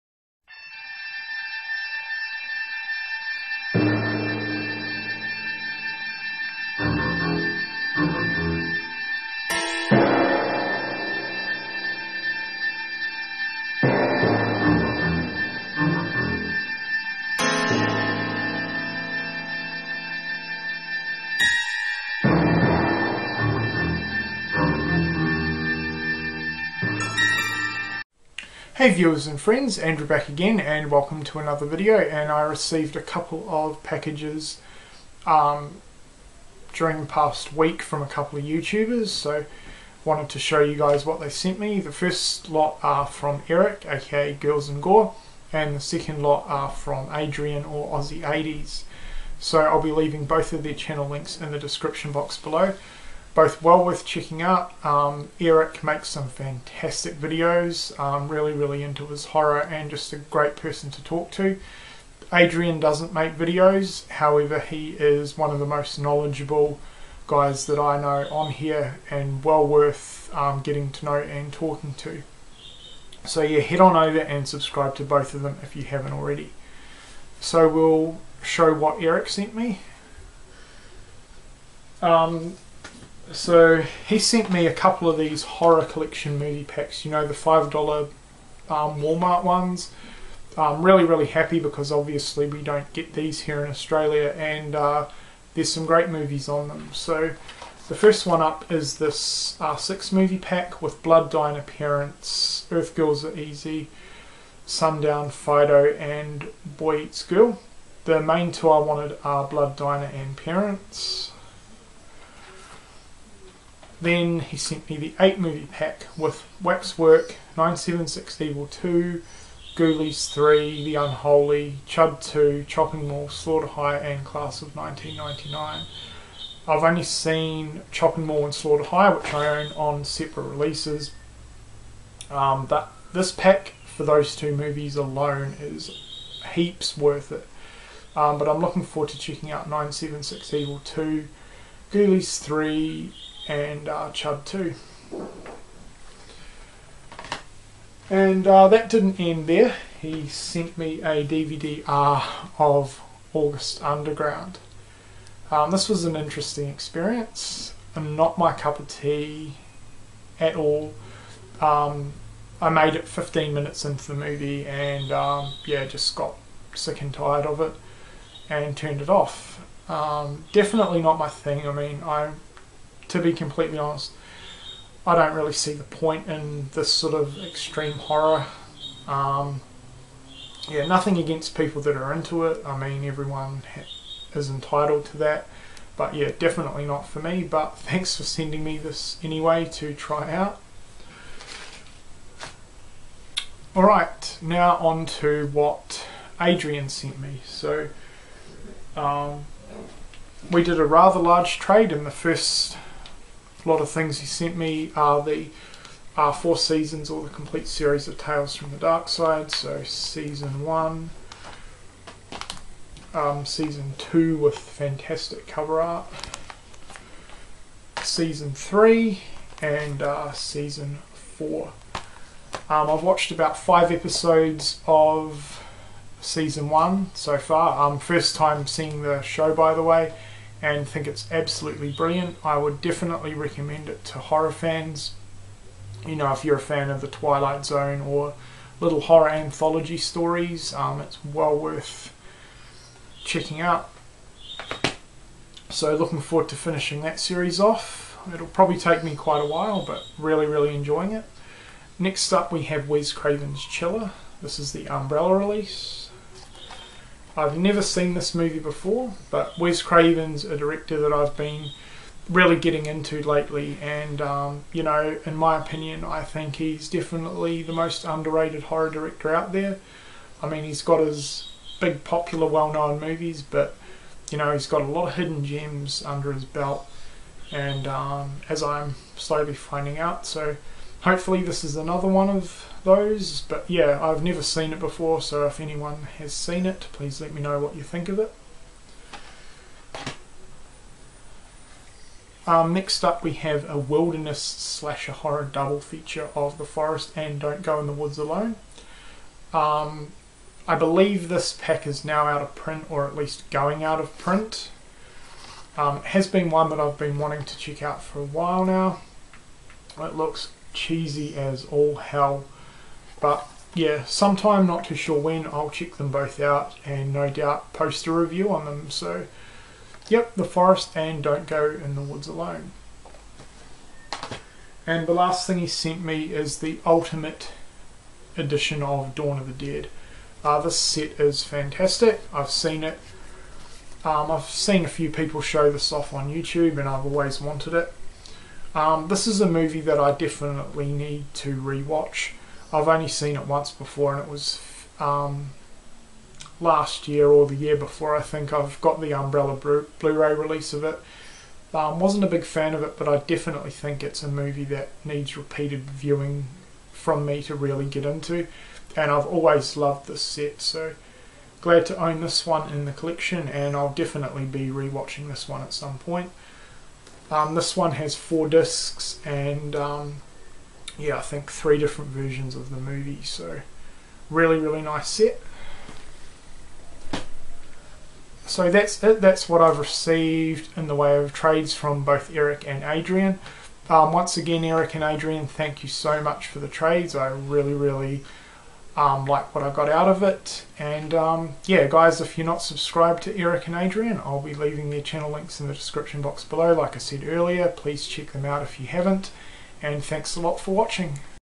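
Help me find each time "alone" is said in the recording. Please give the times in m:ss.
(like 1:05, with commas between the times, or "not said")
2:14, 4:58, 5:22.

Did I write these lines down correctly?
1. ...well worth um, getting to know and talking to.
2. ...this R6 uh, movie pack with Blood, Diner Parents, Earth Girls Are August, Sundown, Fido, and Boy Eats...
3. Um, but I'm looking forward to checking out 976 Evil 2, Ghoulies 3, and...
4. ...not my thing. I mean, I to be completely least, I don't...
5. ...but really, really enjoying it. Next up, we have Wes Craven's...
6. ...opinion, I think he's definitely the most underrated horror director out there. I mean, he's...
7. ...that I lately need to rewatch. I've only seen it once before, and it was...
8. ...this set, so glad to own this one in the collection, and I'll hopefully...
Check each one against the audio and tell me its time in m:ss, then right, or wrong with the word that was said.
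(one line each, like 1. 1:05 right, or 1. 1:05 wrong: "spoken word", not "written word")
1. 1:09 right
2. 1:38 wrong: "Easy", not "August"
3. 2:18 right
4. 2:51 wrong: "honest", not "least"
5. 4:09 right
6. 4:25 right
7. 5:39 wrong: "definitely", not "lately"
8. 6:00 wrong: "definitely", not "hopefully".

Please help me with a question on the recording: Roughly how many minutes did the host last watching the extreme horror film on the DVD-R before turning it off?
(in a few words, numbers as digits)
15.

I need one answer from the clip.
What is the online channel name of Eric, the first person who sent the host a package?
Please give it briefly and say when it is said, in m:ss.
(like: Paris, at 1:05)
Girls and Gore, at 0:44.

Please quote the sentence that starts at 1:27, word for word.
You know the five dollar um, Walmart ones.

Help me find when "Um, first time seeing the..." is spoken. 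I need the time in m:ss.
3:47.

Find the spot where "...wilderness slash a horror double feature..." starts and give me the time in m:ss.
4:53.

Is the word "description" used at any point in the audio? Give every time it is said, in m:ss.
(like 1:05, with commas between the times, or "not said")
0:51, 6:35.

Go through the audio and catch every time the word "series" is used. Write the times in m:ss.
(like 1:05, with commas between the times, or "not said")
3:27, 4:07.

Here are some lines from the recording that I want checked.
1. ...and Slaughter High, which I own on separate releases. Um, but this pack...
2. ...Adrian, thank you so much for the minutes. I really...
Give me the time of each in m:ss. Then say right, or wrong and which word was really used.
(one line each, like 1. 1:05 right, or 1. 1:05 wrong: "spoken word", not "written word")
1. 2:08 right
2. 6:25 wrong: "trades", not "minutes".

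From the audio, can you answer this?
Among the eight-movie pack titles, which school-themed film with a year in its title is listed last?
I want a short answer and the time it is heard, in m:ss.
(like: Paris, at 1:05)
Class of 1999, at 2:04.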